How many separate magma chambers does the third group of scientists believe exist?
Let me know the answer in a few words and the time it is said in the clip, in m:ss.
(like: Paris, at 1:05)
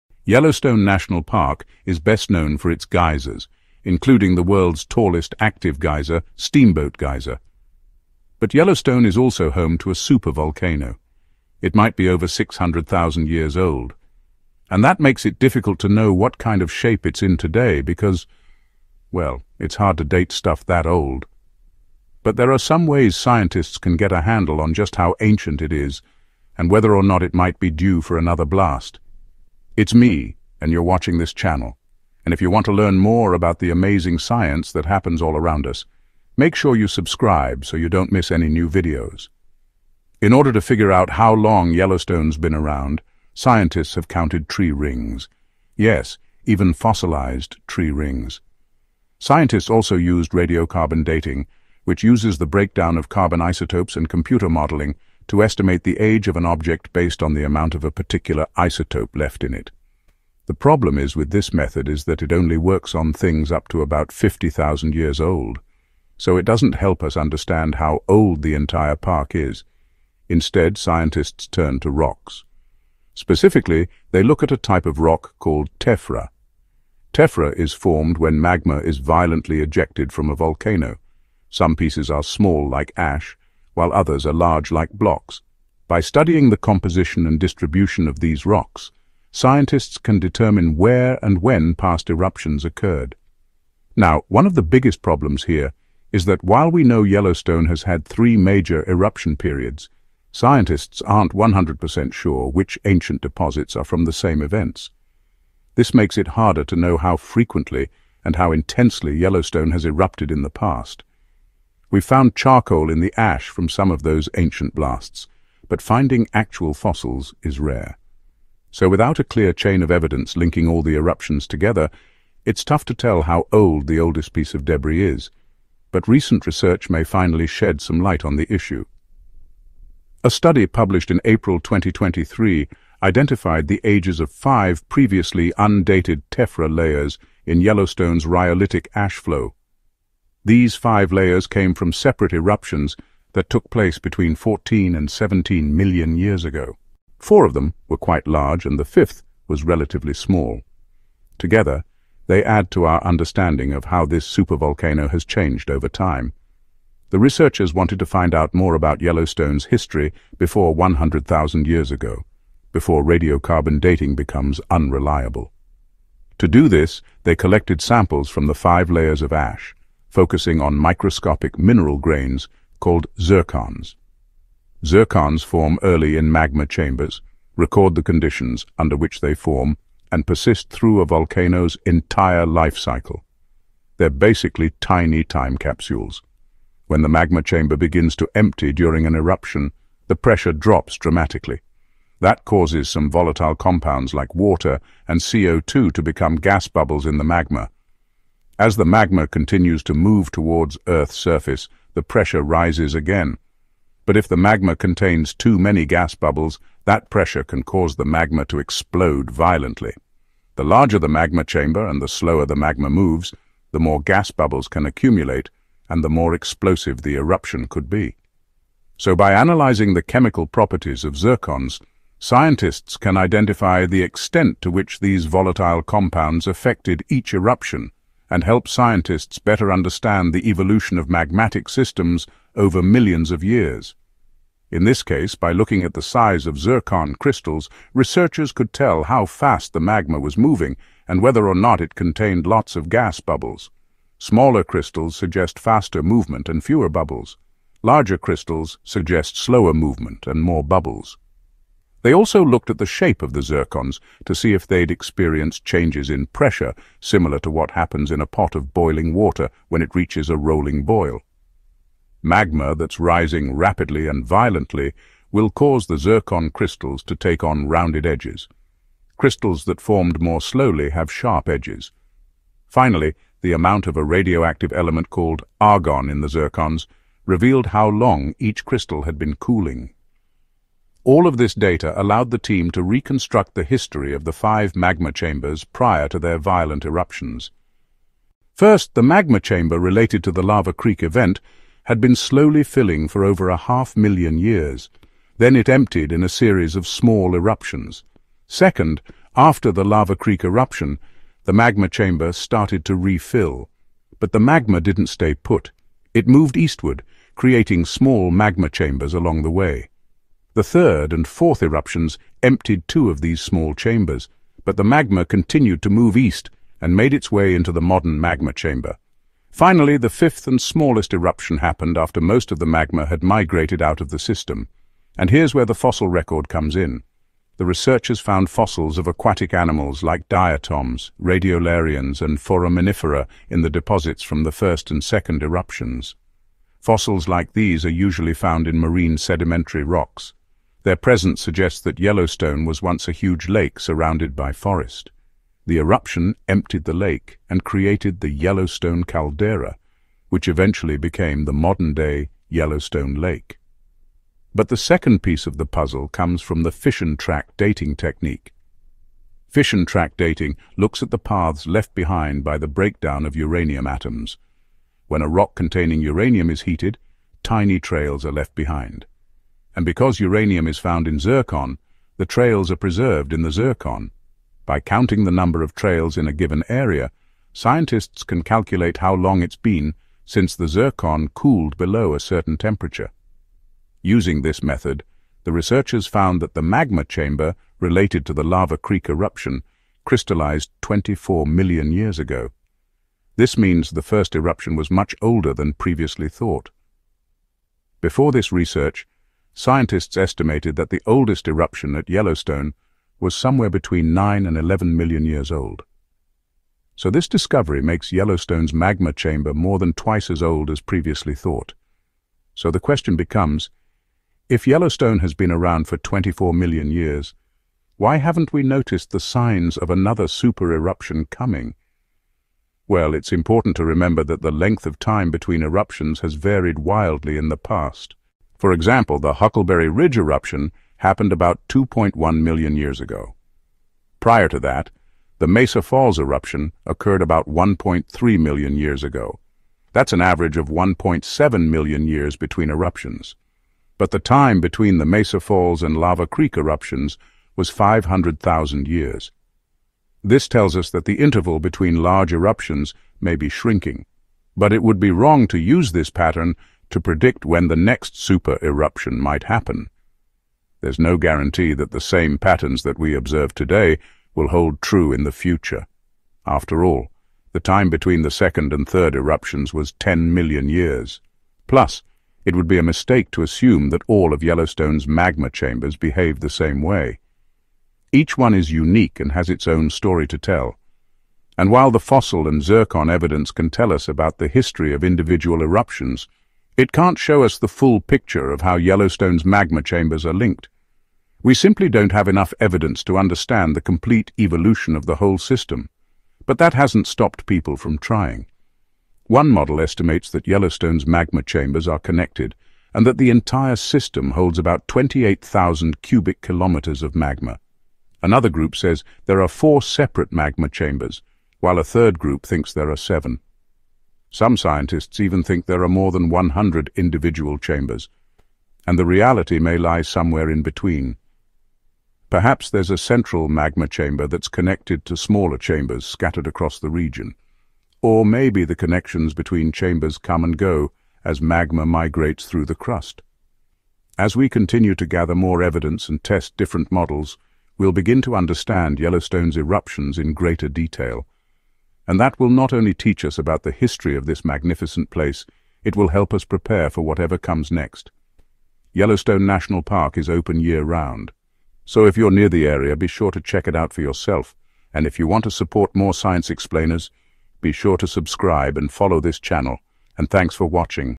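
7, at 8:32.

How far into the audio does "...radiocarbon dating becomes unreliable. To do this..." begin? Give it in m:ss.
2:43.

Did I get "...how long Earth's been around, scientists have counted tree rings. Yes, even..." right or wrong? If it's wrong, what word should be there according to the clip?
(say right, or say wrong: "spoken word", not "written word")
wrong: "Yellowstone", not "Earth".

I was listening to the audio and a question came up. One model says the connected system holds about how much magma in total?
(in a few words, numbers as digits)
28,000 cubic kilometers.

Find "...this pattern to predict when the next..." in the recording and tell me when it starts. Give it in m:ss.
7:35.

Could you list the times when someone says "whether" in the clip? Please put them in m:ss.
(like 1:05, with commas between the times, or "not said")
0:26, 4:01.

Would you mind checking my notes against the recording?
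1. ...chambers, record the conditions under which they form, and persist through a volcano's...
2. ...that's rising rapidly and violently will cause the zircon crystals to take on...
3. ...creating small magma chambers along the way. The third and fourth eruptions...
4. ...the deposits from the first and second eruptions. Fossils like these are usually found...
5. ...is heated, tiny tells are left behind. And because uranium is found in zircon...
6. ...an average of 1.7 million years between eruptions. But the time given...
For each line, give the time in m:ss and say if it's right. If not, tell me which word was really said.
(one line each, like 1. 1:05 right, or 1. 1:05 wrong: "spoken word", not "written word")
1. 2:56 right
2. 4:22 right
3. 5:07 right
4. 5:33 right
5. 6:06 wrong: "trails", not "tells"
6. 7:20 wrong: "between", not "given".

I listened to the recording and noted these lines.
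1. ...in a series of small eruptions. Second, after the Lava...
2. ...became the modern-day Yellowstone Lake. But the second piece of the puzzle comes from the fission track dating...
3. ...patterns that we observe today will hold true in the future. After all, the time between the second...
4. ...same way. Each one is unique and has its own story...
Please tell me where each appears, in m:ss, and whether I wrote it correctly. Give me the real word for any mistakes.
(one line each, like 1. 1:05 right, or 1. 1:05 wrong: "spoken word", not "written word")
1. 4:56 right
2. 5:50 right
3. 7:42 right
4. 7:56 right.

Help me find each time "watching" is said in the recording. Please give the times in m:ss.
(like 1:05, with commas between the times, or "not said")
0:30, 9:20.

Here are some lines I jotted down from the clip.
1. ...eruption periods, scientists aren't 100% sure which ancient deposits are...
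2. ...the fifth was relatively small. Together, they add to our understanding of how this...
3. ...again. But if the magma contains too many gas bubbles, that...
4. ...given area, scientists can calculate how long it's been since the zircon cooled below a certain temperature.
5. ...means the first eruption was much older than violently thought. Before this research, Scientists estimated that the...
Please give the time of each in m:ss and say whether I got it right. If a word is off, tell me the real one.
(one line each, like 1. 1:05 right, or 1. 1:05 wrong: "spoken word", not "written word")
1. 1:38 right
2. 2:28 right
3. 3:22 right
4. 6:16 right
5. 6:33 wrong: "previously", not "violently".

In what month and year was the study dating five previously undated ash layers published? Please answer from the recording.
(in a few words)
April 2023.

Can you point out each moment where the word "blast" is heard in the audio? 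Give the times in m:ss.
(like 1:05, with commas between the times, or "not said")
0:28, 1:54.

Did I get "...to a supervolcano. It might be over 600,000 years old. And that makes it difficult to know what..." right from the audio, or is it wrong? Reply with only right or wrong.
right.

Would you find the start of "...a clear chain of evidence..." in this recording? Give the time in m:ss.
1:59.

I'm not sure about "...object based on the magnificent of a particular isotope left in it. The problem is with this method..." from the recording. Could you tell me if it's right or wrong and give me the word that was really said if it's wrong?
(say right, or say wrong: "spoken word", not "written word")
wrong: "amount", not "magnificent".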